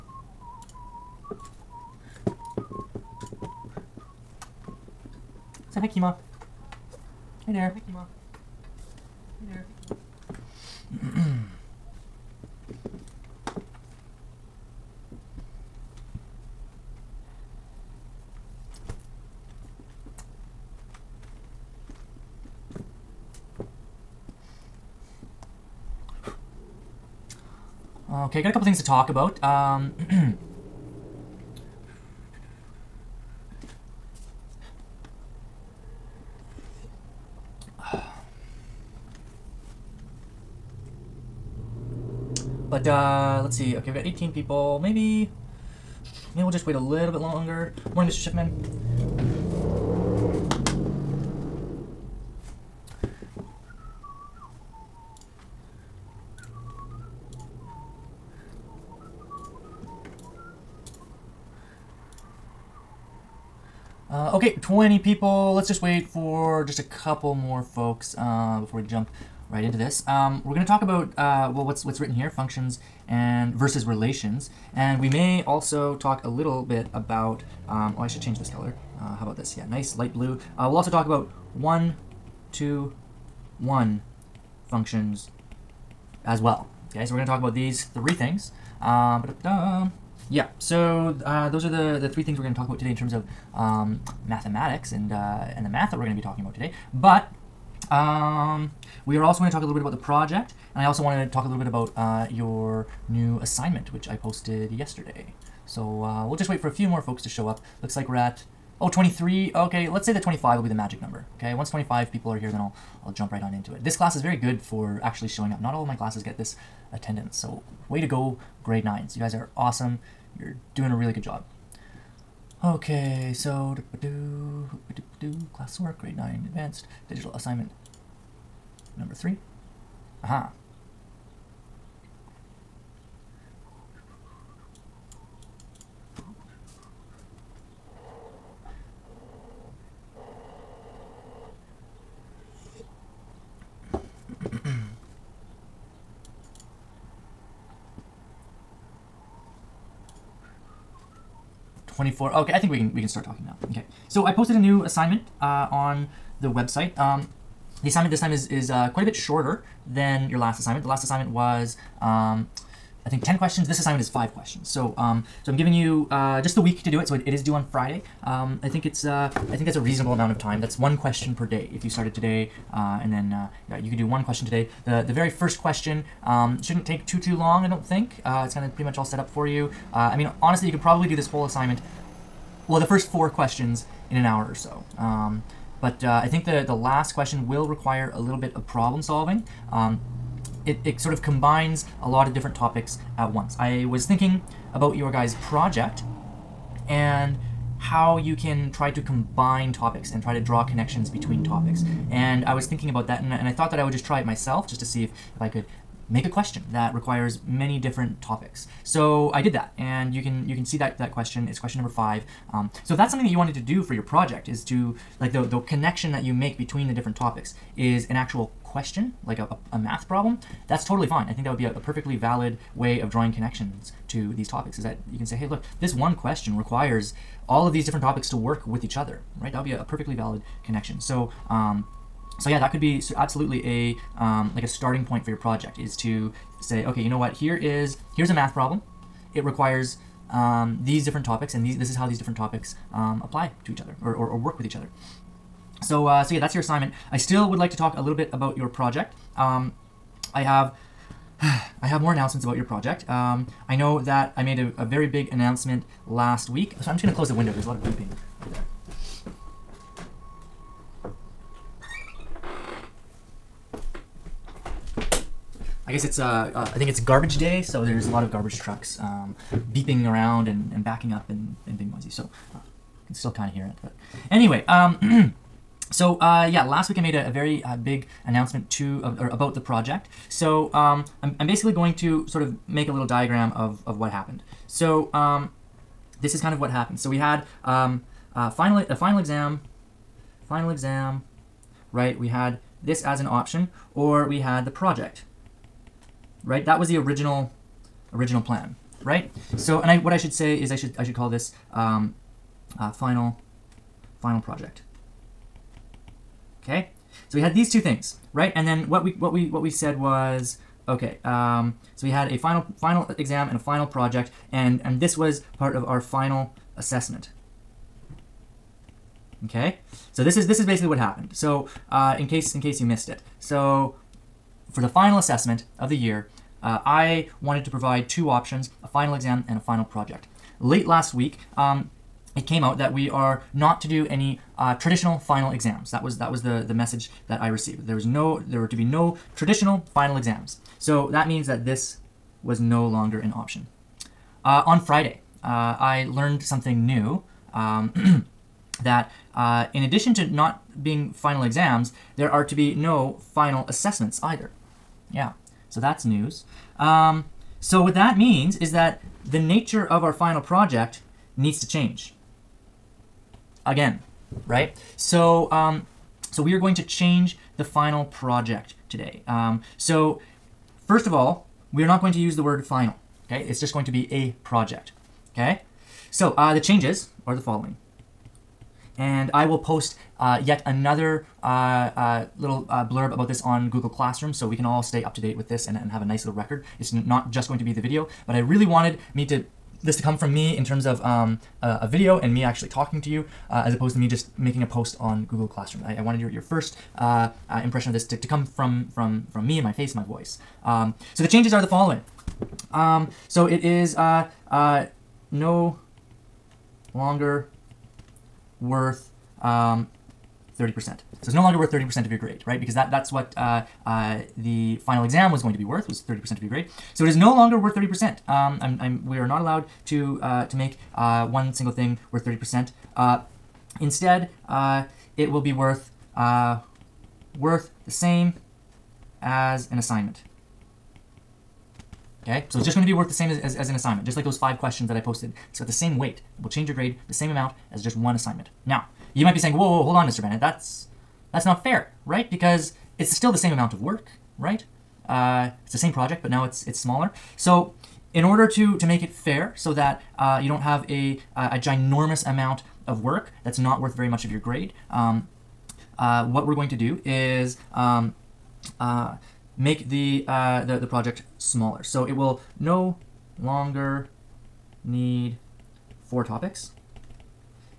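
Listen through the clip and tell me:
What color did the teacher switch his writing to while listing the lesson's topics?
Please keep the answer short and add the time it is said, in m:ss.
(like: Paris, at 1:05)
light blue, at 1:19.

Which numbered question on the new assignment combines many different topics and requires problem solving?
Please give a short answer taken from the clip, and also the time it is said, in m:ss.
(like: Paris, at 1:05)
5, at 3:31.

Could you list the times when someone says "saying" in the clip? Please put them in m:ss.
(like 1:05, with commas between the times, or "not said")
7:19.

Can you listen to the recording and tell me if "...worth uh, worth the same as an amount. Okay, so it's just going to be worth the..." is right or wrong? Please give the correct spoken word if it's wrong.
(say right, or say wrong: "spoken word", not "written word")
wrong: "assignment", not "amount".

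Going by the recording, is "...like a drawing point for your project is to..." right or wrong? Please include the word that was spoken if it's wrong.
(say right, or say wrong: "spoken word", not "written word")
wrong: "starting", not "drawing".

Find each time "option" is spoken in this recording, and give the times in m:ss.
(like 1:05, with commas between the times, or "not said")
4:53, 5:28, 5:43.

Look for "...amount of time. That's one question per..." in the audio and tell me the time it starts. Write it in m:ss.
2:50.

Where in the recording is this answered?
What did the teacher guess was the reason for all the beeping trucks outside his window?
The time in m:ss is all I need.
4:26.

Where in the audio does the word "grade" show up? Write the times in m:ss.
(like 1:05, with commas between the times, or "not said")
1:58, 2:05, 6:52, 6:56, 7:16, 7:34.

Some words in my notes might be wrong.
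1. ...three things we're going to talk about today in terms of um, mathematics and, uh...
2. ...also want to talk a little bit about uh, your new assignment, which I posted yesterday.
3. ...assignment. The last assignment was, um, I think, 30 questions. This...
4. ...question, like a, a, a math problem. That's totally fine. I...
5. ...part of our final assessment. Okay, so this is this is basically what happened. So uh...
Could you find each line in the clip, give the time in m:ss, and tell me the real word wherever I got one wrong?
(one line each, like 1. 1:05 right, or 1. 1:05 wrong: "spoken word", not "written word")
1. 1:32 right
2. 1:40 right
3. 2:40 wrong: "10", not "30"
4. 3:38 right
5. 5:15 right.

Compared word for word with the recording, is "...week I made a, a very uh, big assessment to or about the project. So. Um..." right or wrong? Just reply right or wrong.
wrong.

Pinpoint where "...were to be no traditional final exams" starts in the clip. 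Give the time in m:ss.
5:38.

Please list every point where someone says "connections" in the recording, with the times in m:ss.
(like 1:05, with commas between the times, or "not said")
3:20, 3:35, 3:43, 3:50.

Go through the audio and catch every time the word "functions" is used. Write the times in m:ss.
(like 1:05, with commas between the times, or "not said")
1:12, 1:24.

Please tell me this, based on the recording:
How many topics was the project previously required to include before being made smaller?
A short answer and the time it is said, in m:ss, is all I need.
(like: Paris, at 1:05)
4, at 7:46.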